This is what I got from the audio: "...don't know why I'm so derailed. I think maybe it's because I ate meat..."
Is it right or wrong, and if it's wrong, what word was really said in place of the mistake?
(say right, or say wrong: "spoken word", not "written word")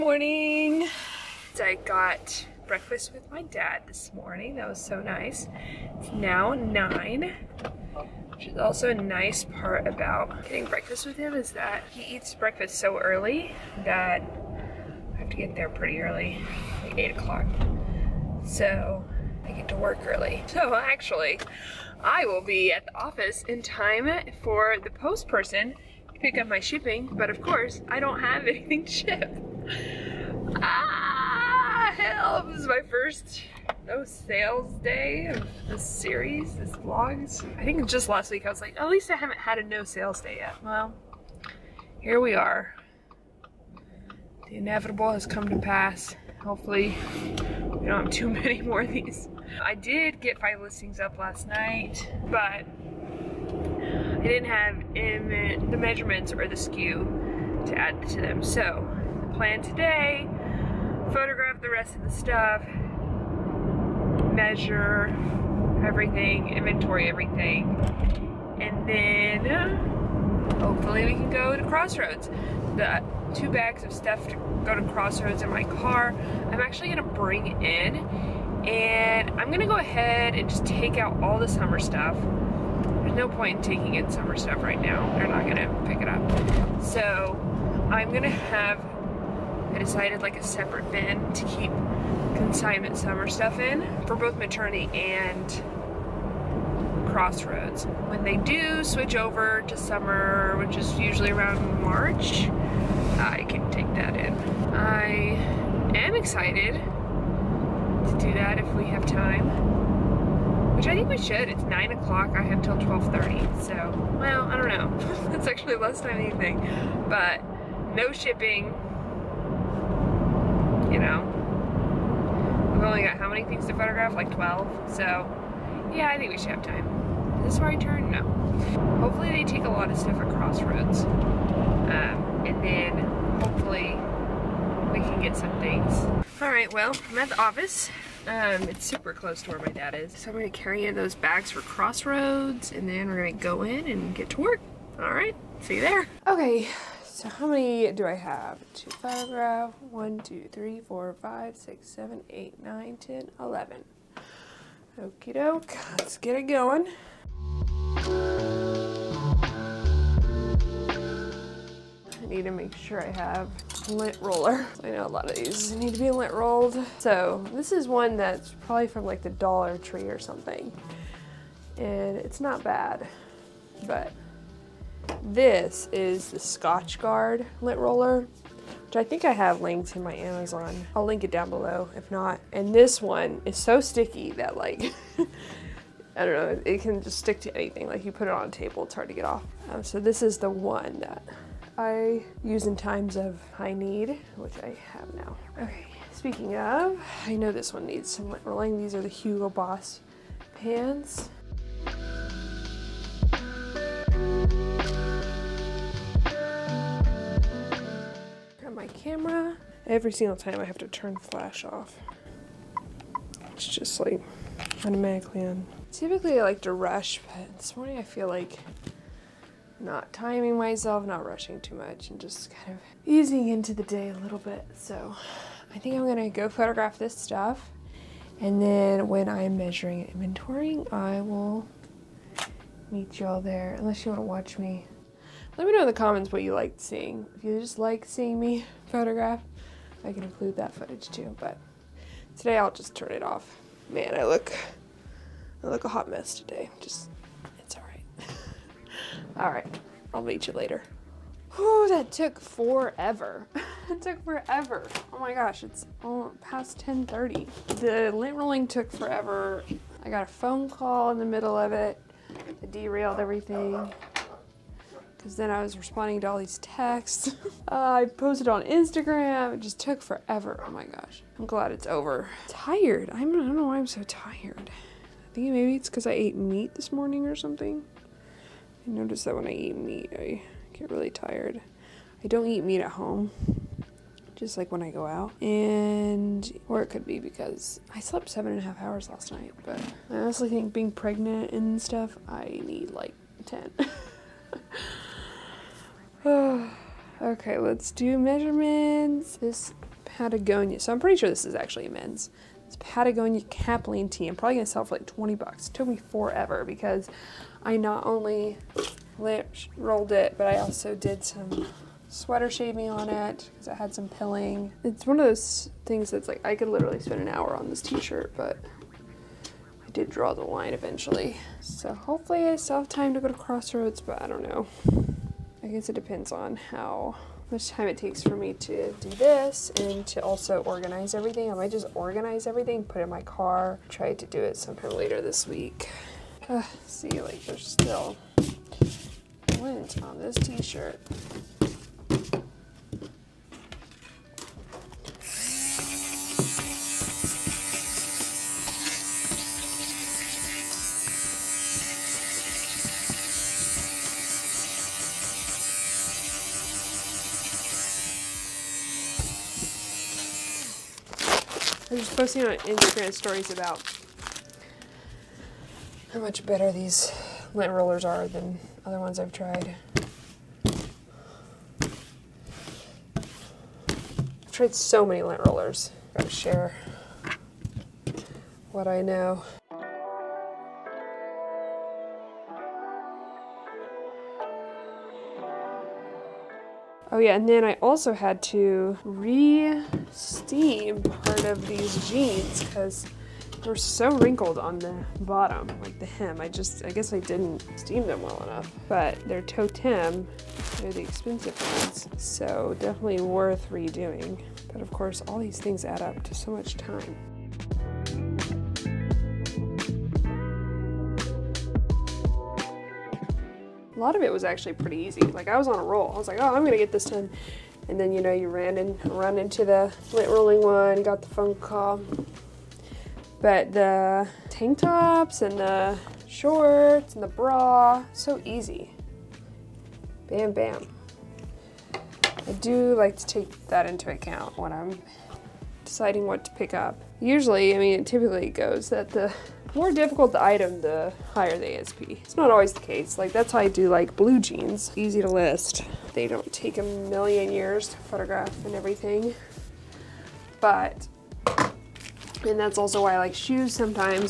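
wrong: "tired", not "derailed".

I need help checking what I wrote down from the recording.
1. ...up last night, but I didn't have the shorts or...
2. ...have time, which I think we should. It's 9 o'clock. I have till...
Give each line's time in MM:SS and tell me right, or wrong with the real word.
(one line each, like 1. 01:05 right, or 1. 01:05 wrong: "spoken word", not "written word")
1. 00:50 wrong: "measurements", not "shorts"
2. 01:48 right.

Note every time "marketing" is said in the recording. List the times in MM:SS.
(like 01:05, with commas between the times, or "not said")
not said.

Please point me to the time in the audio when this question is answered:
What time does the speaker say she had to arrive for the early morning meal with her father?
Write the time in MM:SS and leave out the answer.
00:16.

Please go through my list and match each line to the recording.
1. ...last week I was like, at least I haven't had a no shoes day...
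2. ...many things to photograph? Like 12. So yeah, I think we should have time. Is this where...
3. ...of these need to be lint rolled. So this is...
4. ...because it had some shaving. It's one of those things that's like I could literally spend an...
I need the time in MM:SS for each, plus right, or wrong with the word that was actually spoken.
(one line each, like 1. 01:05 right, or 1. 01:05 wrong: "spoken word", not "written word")
1. 00:38 wrong: "sales", not "shoes"
2. 02:03 right
3. 02:45 right
4. 05:13 wrong: "pilling", not "shaving".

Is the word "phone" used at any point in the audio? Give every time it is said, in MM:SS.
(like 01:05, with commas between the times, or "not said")
04:20, 07:01.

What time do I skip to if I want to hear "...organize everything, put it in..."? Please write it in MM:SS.
05:31.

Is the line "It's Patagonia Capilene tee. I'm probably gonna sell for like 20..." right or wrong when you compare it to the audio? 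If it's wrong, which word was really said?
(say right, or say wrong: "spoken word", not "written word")
right.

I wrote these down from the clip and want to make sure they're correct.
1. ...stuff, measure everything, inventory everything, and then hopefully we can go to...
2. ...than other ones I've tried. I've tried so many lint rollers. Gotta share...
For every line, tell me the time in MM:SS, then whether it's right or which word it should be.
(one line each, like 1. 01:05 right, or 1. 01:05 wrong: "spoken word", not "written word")
1. 01:02 right
2. 06:08 right.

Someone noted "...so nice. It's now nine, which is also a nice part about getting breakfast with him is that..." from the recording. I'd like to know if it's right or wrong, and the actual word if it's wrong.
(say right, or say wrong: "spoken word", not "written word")
right.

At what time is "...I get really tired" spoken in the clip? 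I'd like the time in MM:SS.
04:40.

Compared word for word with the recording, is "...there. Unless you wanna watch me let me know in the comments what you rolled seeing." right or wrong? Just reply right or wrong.
wrong.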